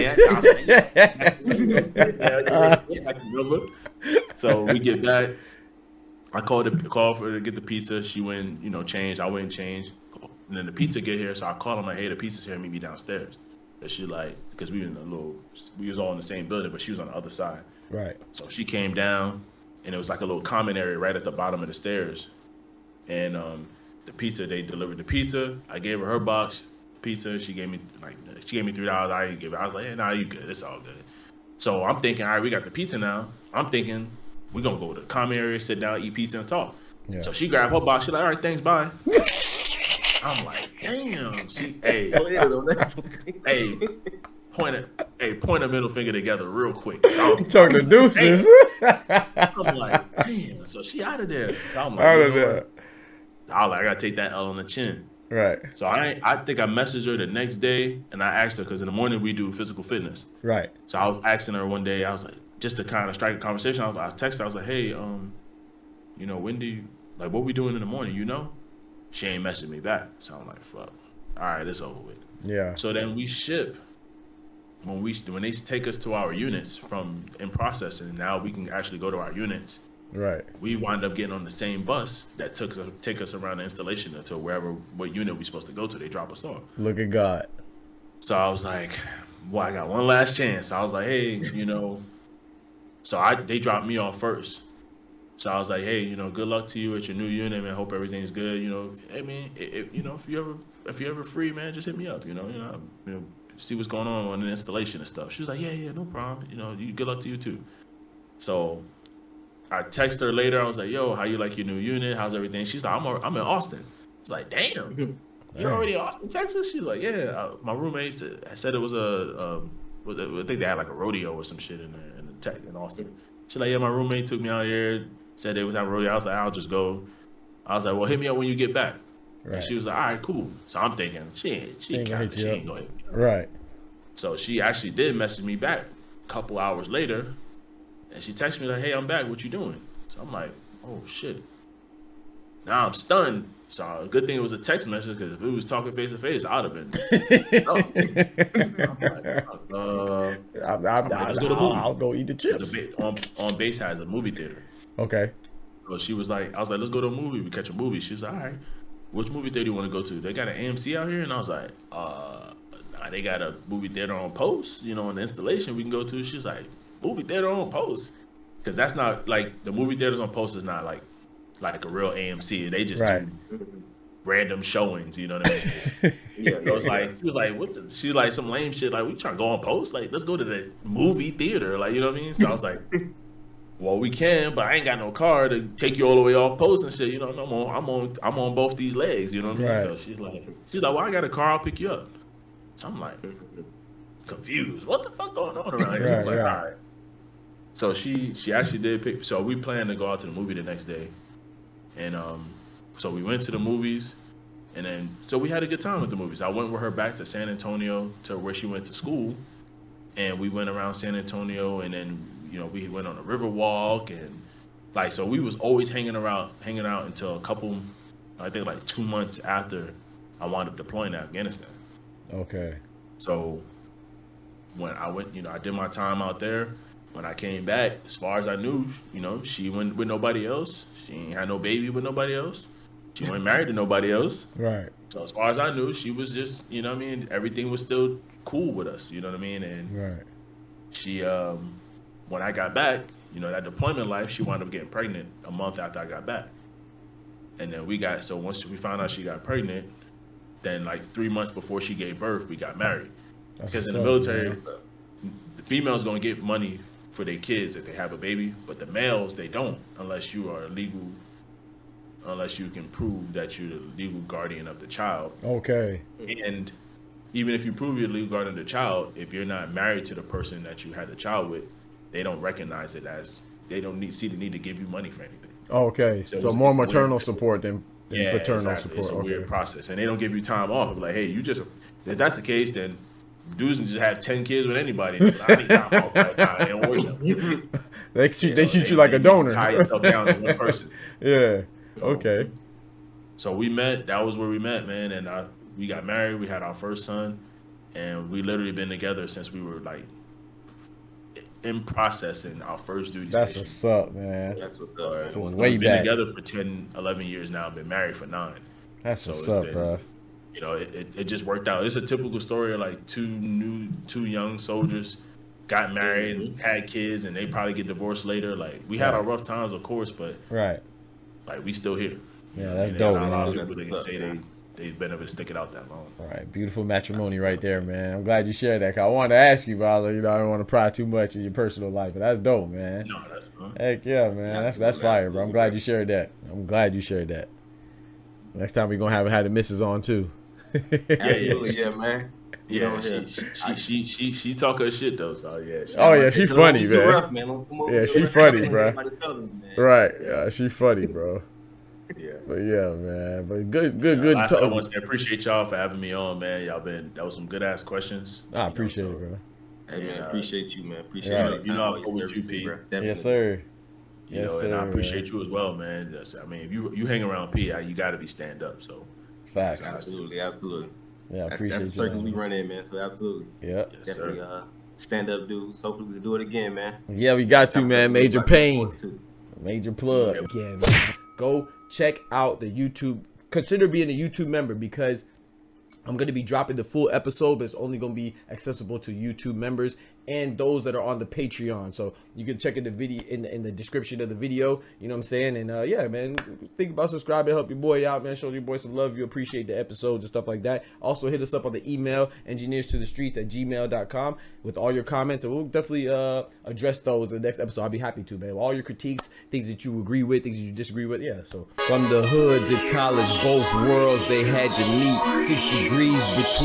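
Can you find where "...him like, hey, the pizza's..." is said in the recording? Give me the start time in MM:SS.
00:11.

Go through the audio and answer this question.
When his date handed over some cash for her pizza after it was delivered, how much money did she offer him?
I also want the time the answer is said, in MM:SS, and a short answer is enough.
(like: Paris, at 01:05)
$3, at 00:28.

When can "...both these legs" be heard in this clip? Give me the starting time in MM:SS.
03:08.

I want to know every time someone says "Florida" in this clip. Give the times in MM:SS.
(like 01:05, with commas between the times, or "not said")
not said.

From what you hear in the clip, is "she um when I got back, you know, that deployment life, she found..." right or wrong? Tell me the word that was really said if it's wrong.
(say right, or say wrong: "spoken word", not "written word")
wrong: "wound", not "found".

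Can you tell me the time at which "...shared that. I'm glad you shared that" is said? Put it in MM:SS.
05:35.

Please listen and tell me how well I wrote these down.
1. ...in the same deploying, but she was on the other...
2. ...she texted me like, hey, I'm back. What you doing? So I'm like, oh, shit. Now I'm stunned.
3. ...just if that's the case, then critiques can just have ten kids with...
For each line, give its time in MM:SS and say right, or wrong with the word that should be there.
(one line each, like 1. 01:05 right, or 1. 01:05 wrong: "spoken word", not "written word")
1. 00:16 wrong: "building", not "deploying"
2. 02:18 right
3. 04:41 wrong: "dudes", not "critiques".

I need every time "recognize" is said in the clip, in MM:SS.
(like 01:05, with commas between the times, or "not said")
04:32.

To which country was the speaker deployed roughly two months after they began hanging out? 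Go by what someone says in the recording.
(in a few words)
Afghanistan.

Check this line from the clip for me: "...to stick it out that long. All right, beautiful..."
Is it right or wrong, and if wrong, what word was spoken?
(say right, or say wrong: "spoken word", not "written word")
right.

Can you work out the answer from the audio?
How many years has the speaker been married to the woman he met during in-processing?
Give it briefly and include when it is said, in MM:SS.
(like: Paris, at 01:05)
9, at 05:08.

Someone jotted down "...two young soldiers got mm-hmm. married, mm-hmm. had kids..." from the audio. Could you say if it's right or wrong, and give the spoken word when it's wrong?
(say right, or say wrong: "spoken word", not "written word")
right.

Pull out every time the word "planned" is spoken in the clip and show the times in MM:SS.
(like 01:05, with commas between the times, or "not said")
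03:19.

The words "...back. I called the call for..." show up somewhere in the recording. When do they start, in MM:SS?
00:05.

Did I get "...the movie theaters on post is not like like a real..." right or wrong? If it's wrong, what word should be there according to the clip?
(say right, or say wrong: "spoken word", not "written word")
right.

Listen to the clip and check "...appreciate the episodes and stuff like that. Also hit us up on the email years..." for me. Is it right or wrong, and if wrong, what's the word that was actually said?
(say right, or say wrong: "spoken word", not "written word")
wrong: "engineers", not "years".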